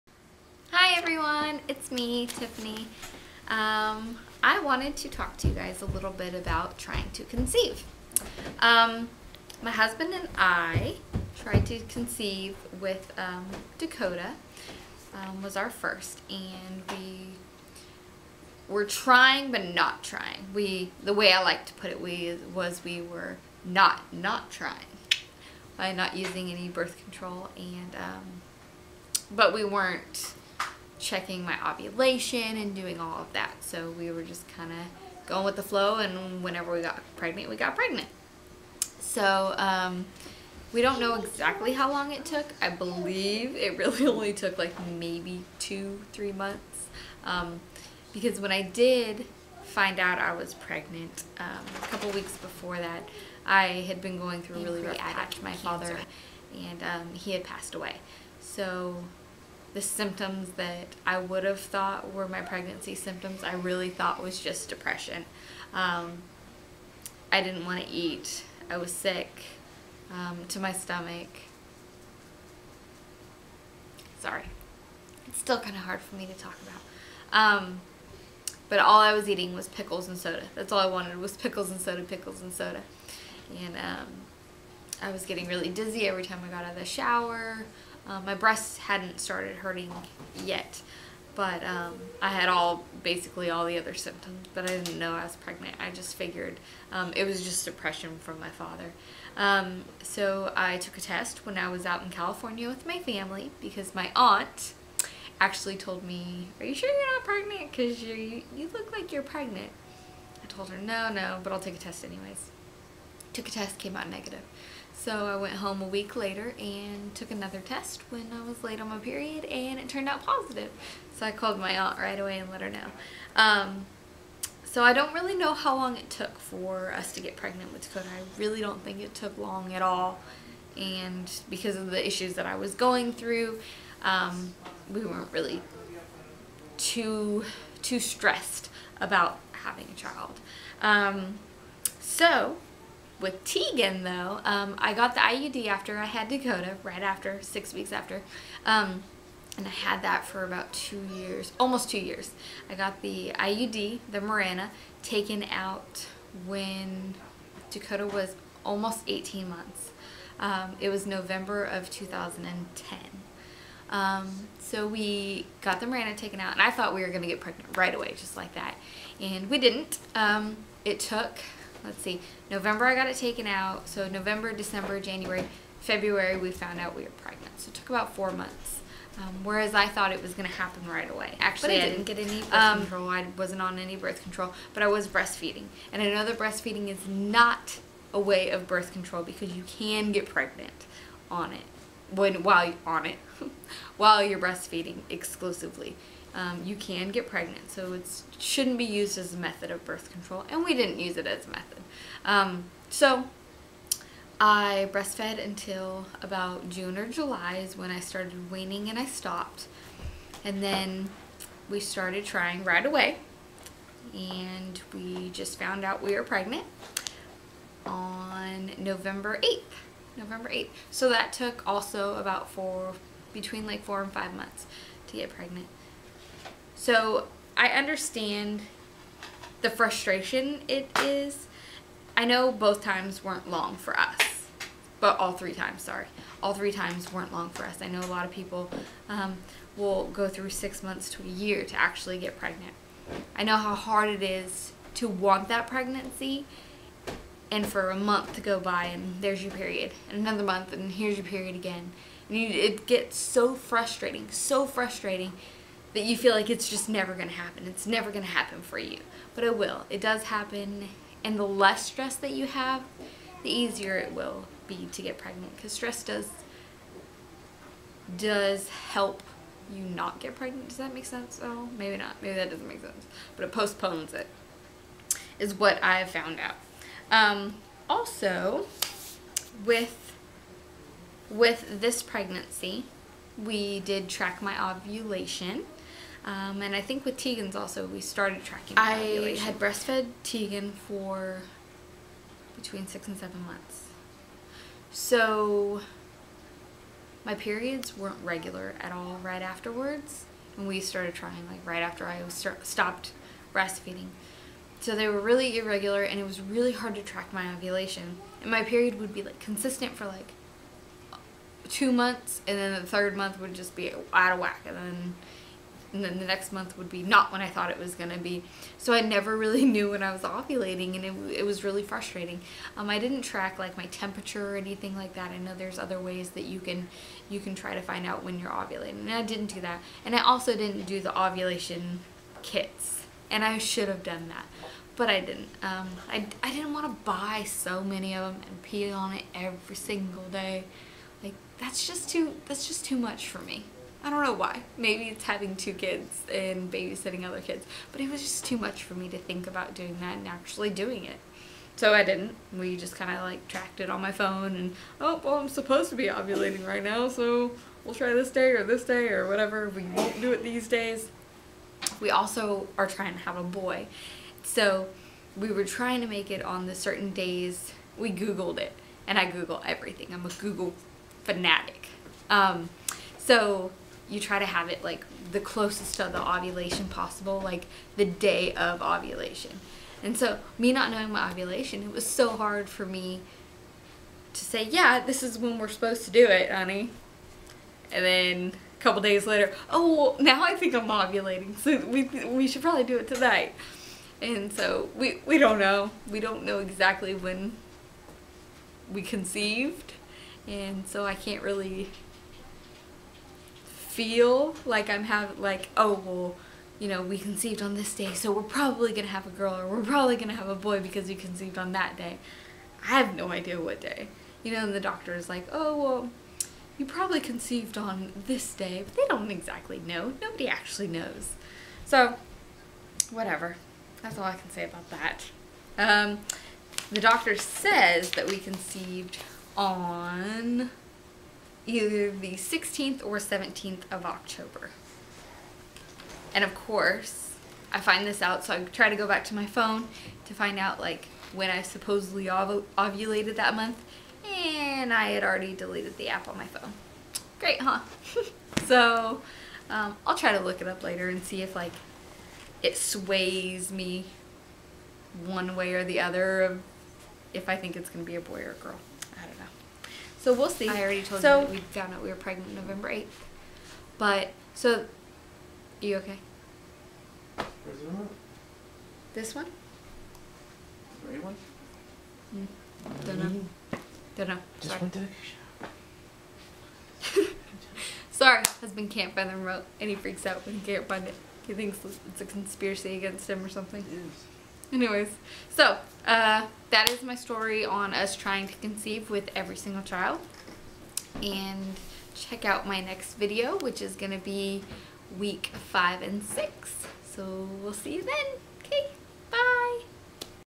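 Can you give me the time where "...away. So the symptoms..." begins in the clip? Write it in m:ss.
0:57.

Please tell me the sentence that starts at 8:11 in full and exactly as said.
And check out my next video, which is going to be week five and six.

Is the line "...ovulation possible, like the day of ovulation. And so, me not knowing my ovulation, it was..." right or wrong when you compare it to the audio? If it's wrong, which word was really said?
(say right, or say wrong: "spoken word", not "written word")
right.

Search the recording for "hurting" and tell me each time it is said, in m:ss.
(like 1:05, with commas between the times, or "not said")
1:29.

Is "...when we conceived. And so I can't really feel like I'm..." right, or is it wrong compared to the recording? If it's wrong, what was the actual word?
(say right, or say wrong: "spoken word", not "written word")
right.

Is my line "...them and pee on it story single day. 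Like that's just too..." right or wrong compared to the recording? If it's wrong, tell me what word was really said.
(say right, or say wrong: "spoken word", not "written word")
wrong: "every", not "story".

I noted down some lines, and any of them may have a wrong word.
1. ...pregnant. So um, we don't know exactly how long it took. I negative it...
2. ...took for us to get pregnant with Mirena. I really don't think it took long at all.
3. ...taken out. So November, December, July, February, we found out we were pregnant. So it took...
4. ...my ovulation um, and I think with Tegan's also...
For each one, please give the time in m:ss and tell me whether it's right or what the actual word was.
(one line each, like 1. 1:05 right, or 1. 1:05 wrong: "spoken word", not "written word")
1. 0:37 wrong: "believe", not "negative"
2. 2:06 wrong: "Dakota", not "Mirena"
3. 2:53 wrong: "January", not "July"
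4. 4:44 right.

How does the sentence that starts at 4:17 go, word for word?
It's never going to happen for you.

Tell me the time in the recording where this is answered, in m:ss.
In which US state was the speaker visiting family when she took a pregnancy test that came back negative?
1:42.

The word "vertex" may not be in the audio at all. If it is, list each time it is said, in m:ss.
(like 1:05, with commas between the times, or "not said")
not said.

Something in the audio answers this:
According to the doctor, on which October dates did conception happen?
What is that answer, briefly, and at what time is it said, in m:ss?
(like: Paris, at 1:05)
October 16 or 17, at 7:12.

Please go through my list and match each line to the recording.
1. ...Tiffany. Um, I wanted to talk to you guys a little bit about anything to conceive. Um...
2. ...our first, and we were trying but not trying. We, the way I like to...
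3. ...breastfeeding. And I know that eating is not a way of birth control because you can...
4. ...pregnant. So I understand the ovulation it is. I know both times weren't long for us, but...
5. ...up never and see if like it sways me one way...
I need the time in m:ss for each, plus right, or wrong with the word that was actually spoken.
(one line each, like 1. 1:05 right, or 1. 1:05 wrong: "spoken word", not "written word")
1. 0:02 wrong: "trying", not "anything"
2. 0:15 right
3. 3:05 wrong: "breastfeeding", not "eating"
4. 3:45 wrong: "frustration", not "ovulation"
5. 7:30 wrong: "later", not "never".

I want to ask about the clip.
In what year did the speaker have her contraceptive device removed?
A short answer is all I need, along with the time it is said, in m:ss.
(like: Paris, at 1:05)
2010, at 2:41.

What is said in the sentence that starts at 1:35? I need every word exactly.
I just figured um, it was just depression from my father.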